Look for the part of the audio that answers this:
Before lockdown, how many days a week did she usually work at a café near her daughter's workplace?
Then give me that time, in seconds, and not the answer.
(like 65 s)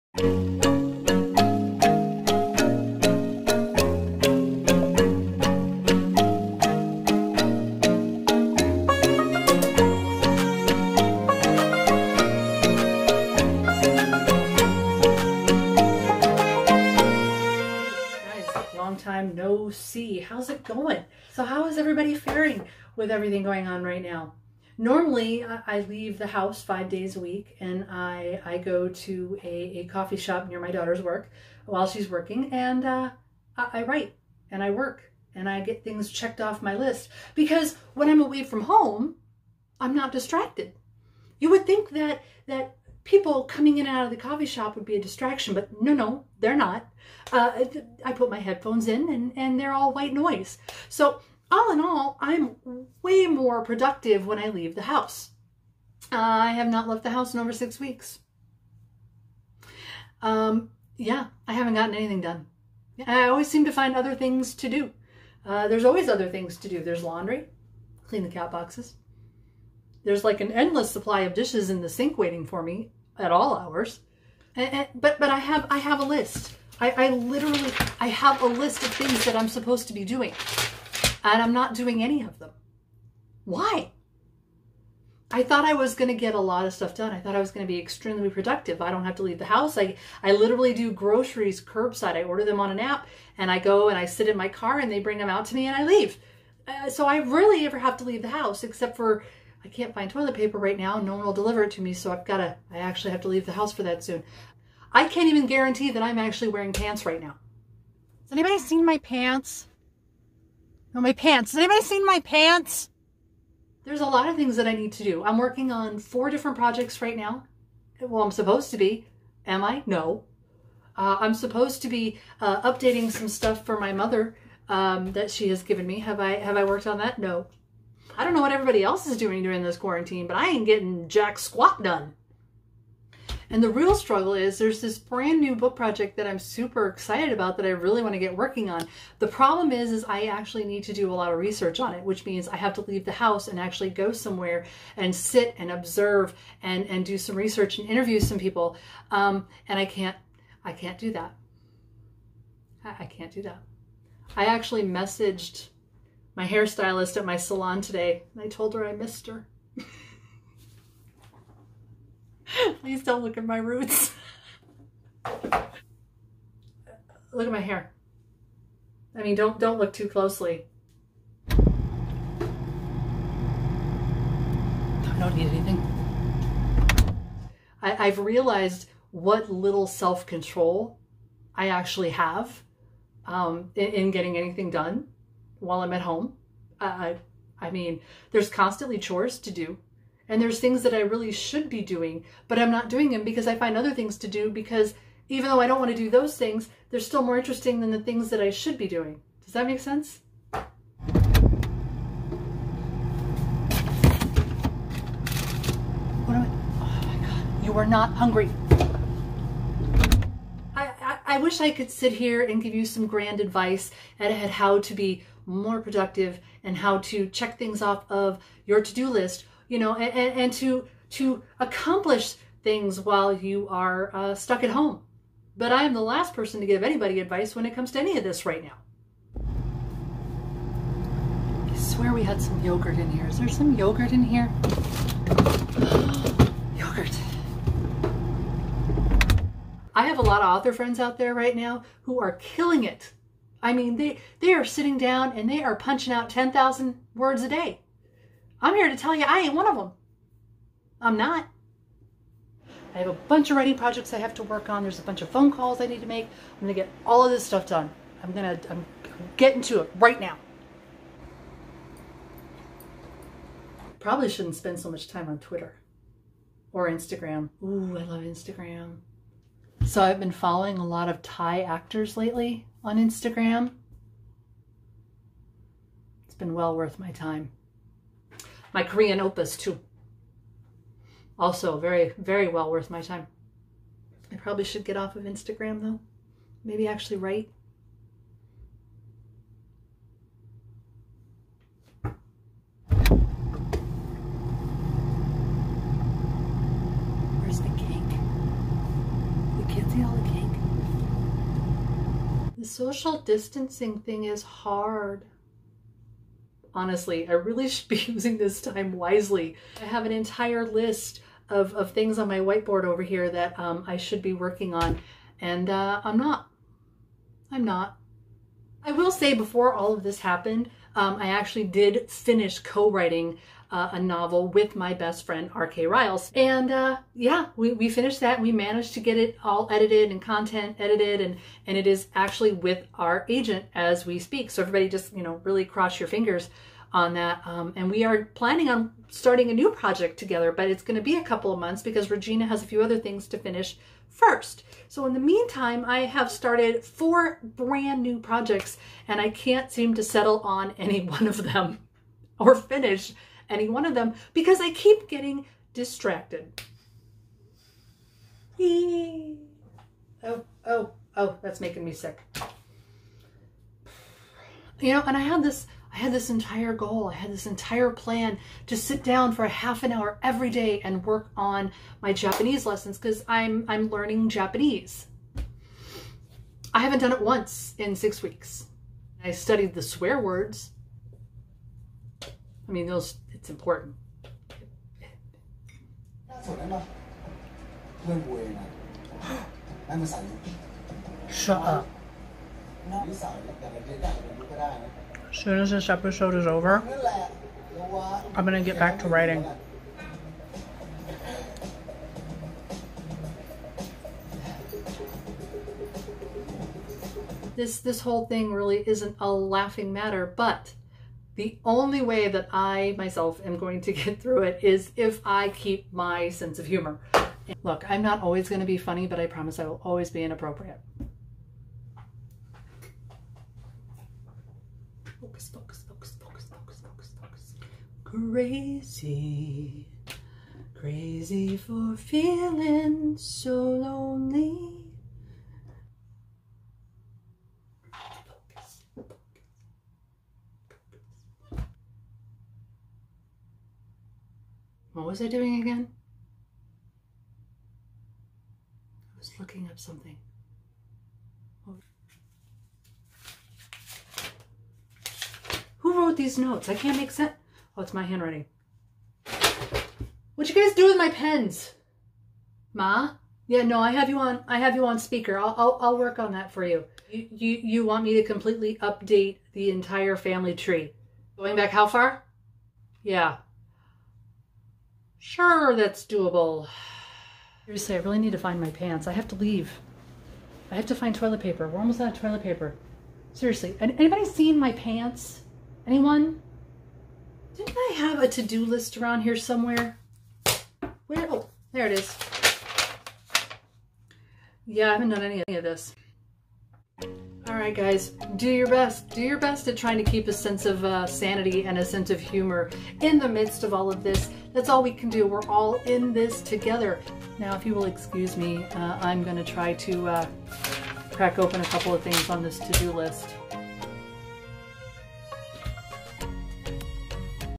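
26 s.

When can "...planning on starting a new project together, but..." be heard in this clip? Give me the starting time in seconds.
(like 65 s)
338 s.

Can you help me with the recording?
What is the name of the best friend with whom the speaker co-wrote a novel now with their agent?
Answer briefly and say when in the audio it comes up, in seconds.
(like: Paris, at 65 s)
R.K. Ryals, at 325 s.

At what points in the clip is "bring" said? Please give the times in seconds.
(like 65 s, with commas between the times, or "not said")
94 s.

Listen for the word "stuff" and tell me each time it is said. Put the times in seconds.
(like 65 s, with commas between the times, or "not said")
86 s, 123 s, 257 s.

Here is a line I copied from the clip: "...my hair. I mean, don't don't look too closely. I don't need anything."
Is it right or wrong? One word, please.
right.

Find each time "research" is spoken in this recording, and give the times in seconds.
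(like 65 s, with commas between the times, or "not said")
141 s, 147 s.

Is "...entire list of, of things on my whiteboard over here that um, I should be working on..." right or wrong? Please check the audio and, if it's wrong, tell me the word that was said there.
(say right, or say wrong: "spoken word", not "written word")
right.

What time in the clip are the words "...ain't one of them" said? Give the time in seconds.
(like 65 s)
249 s.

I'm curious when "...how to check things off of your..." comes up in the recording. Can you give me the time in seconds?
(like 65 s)
216 s.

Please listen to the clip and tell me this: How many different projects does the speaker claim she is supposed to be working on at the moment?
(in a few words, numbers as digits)
4.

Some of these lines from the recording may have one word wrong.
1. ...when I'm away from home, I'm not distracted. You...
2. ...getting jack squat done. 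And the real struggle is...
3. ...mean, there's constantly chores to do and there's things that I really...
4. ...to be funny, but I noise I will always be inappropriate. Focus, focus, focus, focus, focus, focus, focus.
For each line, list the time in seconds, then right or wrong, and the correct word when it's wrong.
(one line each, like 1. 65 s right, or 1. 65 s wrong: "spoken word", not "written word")
1. 37 s right
2. 130 s right
3. 187 s right
4. 418 s wrong: "promise", not "noise".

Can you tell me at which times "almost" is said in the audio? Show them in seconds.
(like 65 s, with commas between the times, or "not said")
481 s.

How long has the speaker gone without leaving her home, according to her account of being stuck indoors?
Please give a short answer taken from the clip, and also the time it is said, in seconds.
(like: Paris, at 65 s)
Over six weeks, at 57 s.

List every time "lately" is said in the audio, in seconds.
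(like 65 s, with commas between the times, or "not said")
272 s.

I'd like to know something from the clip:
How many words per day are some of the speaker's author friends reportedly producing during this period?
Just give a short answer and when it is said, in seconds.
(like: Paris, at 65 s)
10,000, at 246 s.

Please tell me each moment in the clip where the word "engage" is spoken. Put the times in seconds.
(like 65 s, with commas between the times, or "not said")
not said.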